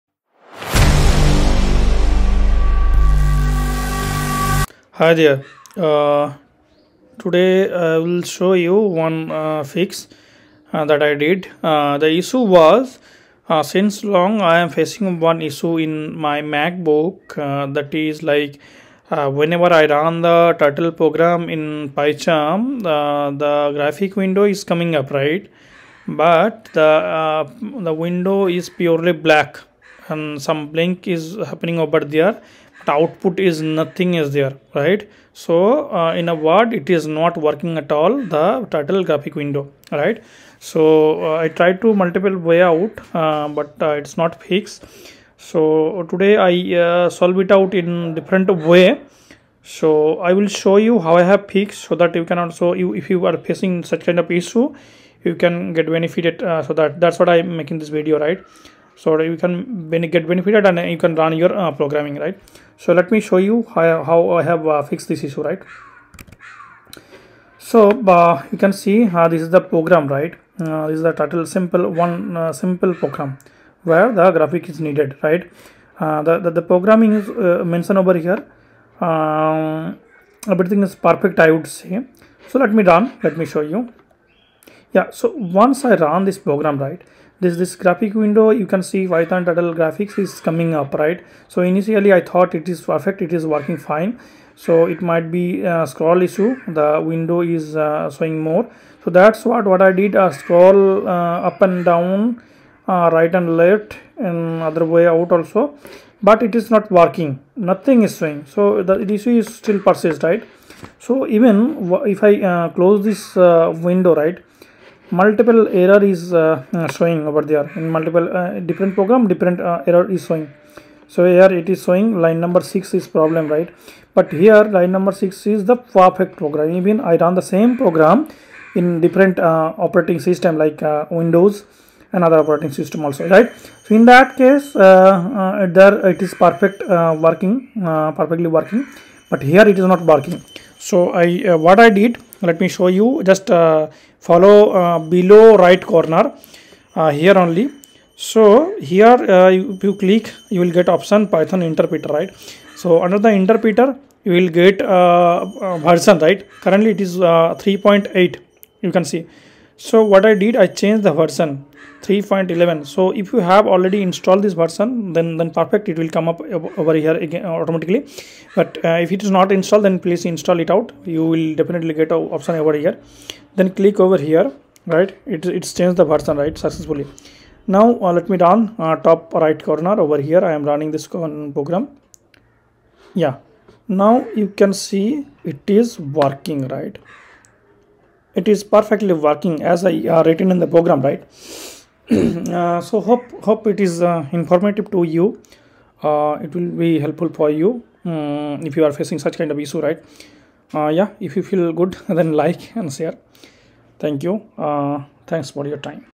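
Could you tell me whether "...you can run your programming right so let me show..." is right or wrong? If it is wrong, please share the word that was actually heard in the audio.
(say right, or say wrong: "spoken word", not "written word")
right.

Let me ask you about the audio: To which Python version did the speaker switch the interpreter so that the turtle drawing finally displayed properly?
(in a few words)
3.11.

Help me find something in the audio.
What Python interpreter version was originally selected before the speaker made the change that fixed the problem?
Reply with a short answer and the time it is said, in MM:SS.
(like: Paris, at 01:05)
3.8, at 02:37.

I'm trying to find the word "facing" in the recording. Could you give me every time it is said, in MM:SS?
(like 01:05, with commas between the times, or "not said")
00:14, 00:53, 03:18.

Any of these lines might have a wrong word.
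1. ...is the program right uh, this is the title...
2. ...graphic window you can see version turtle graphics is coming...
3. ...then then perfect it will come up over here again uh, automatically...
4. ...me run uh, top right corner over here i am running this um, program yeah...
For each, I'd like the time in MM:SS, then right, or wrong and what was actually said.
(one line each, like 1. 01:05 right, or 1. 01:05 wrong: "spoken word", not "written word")
1. 01:09 right
2. 01:27 wrong: "python", not "version"
3. 02:45 right
4. 02:58 right.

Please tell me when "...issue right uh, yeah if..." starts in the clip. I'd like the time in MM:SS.
03:19.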